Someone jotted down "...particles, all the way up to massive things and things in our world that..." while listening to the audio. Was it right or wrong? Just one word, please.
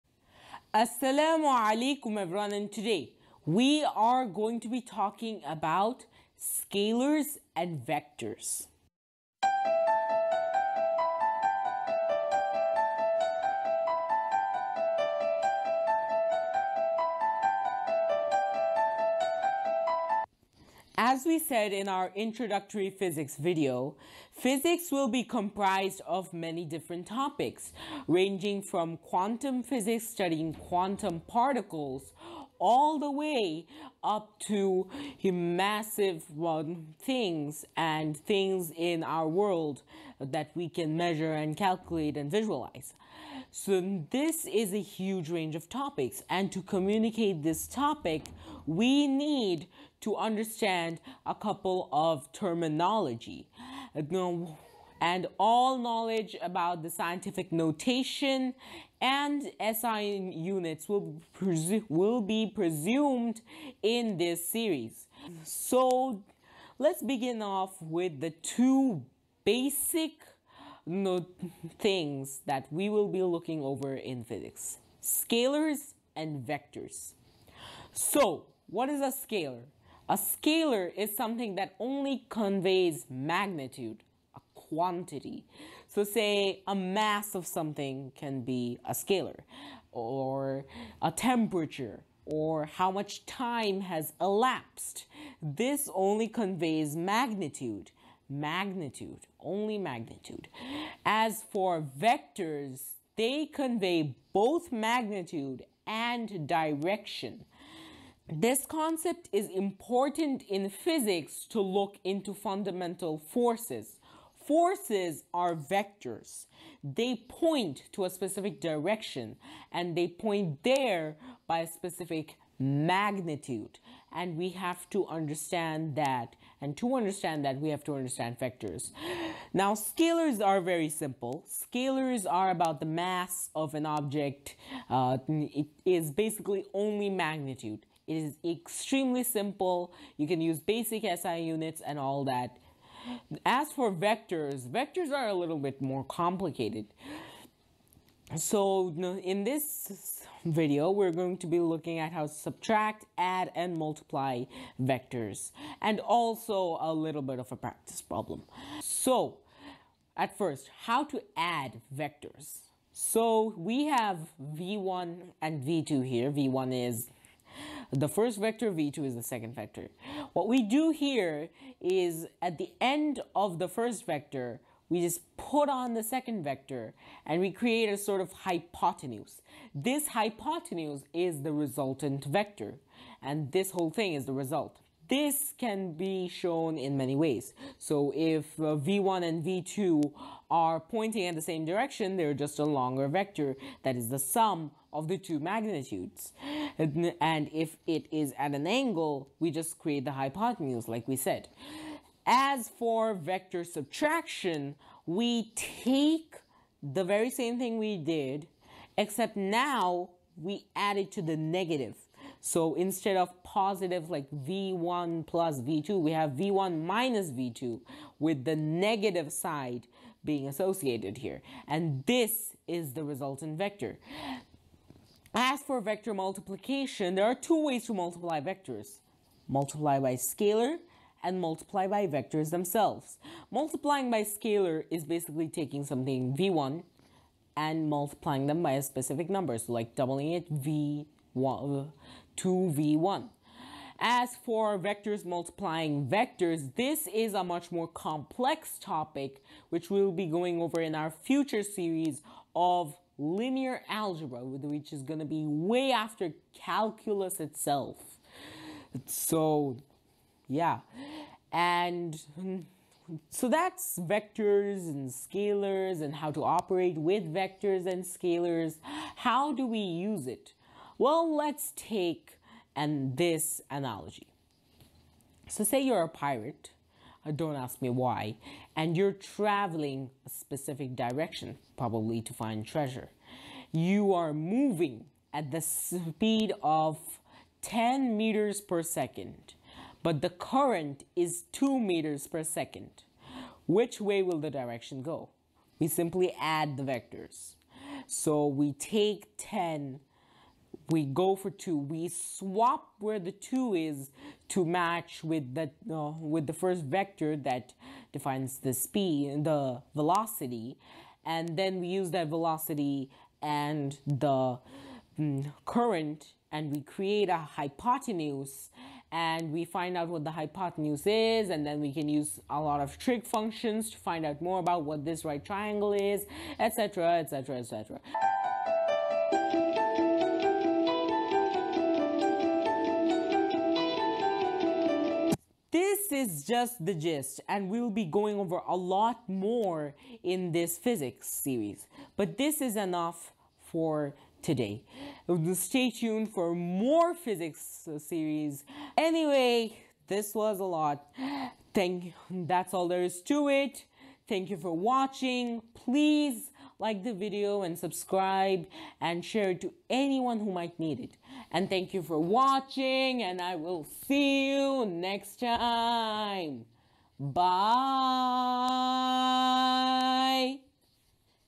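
right.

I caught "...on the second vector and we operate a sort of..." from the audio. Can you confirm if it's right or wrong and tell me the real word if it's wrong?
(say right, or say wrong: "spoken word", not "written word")
wrong: "create", not "operate".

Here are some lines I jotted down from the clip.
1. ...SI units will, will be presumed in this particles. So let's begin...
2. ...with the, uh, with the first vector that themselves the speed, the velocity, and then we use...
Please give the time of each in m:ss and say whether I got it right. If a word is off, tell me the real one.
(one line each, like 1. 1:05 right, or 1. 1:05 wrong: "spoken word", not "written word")
1. 0:59 wrong: "series", not "particles"
2. 5:05 wrong: "defines", not "themselves".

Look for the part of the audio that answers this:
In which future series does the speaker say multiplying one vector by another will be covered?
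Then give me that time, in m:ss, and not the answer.
4:13.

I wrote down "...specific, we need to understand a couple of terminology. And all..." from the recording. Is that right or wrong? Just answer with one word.
wrong.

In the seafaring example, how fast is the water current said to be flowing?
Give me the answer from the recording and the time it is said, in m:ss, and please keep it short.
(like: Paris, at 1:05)
2 meters per second, at 4:51.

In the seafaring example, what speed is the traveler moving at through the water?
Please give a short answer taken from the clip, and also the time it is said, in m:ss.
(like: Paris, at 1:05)
10 meters per second, at 4:47.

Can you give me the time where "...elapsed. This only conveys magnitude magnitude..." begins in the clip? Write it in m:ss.
1:34.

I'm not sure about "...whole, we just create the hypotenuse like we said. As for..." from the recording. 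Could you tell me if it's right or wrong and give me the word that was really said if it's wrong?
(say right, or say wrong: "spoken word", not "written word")
wrong: "angle", not "whole".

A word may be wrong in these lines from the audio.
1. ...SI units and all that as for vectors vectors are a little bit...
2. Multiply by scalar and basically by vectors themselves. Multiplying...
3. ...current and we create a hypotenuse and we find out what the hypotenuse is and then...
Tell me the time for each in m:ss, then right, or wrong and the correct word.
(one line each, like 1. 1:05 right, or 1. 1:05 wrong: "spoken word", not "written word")
1. 2:21 right
2. 3:49 wrong: "multiply", not "basically"
3. 5:15 right.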